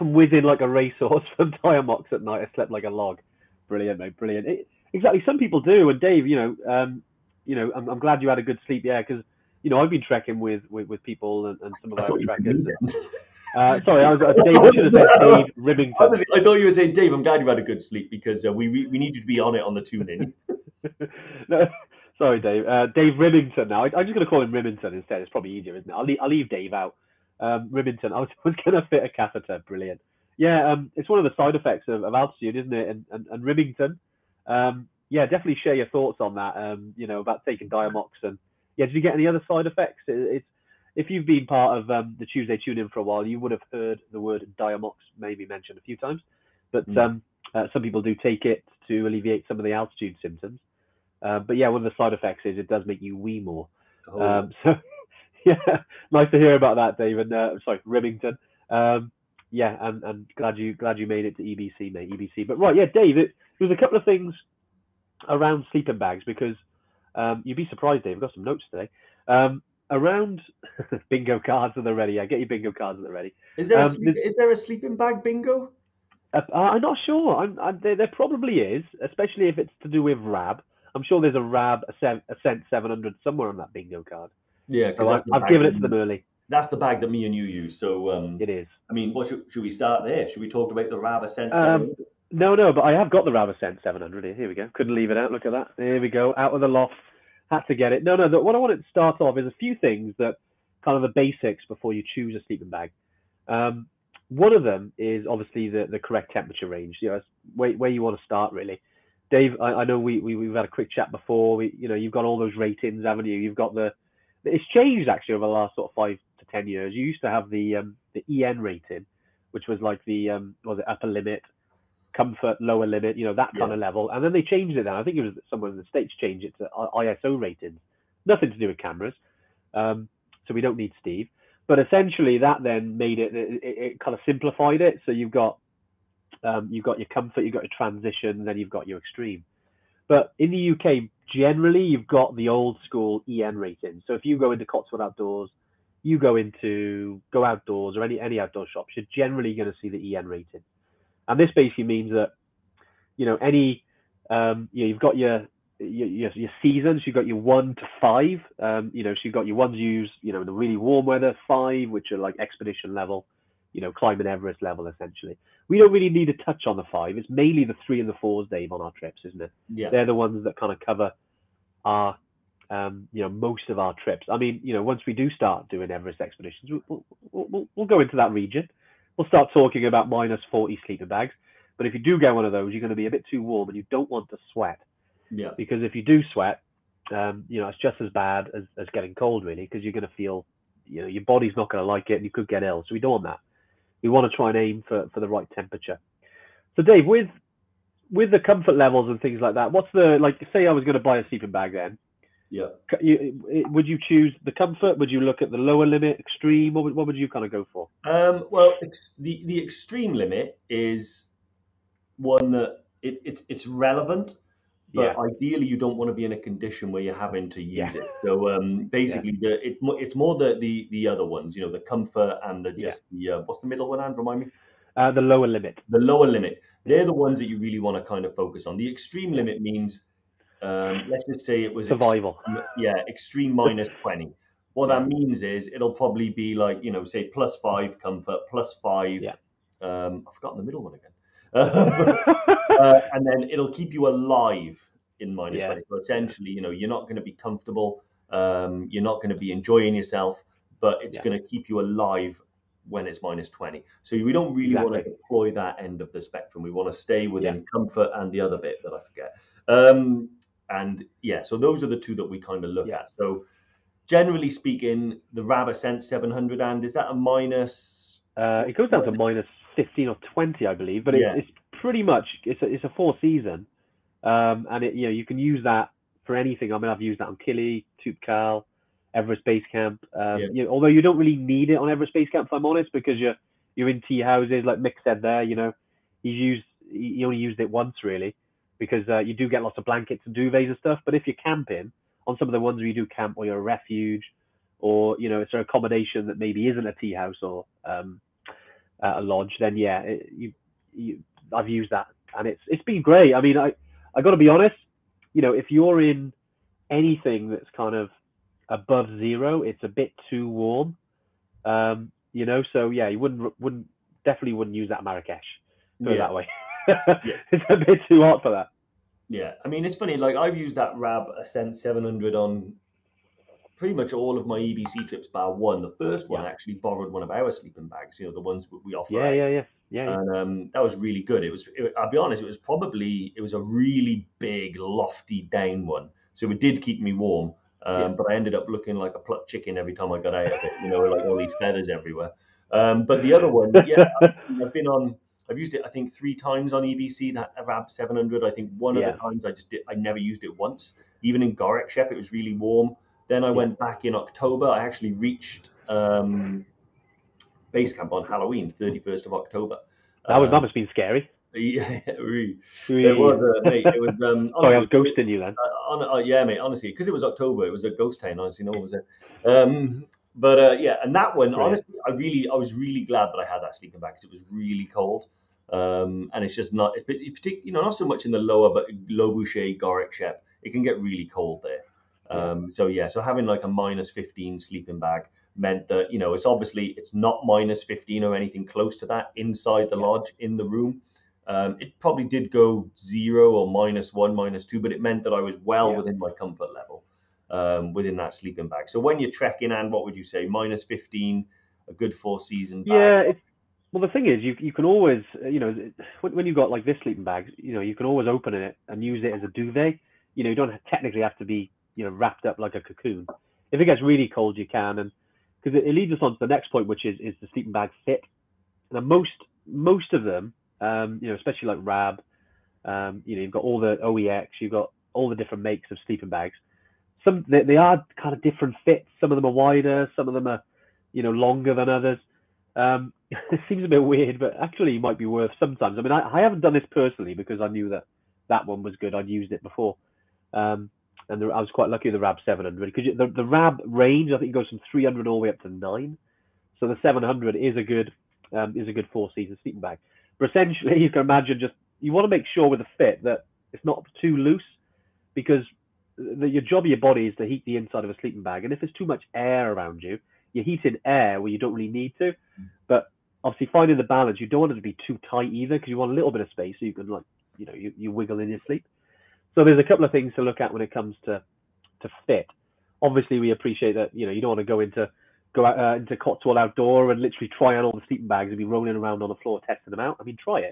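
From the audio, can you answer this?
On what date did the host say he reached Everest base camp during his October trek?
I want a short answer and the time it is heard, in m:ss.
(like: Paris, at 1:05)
31 October, at 5:58.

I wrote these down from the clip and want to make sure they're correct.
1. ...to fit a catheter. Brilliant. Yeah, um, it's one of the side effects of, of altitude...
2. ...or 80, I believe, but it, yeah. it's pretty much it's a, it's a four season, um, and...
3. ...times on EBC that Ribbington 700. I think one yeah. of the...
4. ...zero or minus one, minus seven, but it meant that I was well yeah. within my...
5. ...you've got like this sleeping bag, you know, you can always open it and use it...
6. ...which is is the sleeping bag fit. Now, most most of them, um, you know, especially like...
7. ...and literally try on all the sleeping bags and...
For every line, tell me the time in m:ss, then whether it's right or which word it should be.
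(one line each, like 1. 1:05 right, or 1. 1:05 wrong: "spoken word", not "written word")
1. 0:28 right
2. 4:30 wrong: "20", not "80"
3. 5:46 wrong: "Arab", not "Ribbington"
4. 6:32 wrong: "two", not "seven"
5. 6:46 right
6. 6:56 right
7. 7:57 right.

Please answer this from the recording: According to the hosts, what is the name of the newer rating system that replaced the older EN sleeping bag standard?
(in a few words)
ISO ratings.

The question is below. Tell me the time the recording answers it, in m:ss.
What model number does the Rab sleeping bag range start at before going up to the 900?
7:24.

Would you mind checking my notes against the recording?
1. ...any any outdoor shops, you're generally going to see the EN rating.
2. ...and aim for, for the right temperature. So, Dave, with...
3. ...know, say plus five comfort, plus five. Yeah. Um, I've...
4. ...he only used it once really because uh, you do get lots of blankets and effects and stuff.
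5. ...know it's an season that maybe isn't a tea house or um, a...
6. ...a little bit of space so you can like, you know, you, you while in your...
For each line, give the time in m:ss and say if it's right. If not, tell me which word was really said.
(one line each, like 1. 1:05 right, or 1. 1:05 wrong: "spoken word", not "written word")
1. 2:28 right
2. 3:14 right
3. 3:56 right
4. 4:46 wrong: "duvets", not "effects"
5. 4:55 wrong: "accommodation", not "season"
6. 7:46 wrong: "wiggle", not "while".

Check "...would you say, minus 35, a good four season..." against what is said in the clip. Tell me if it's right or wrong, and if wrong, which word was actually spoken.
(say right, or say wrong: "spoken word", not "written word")
wrong: "15", not "35".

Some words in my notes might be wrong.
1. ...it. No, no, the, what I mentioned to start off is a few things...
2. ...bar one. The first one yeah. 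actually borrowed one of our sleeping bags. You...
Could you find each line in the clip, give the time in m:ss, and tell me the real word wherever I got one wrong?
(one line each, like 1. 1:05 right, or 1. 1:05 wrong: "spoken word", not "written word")
1. 1:37 wrong: "wanted", not "mentioned"
2. 5:25 right.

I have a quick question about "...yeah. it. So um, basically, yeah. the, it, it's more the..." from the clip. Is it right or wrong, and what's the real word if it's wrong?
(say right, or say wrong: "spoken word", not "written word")
right.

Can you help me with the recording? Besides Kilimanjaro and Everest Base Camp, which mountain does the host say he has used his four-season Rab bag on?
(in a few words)
Toubkal.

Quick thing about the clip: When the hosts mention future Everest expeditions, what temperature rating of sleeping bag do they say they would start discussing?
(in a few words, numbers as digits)
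-40.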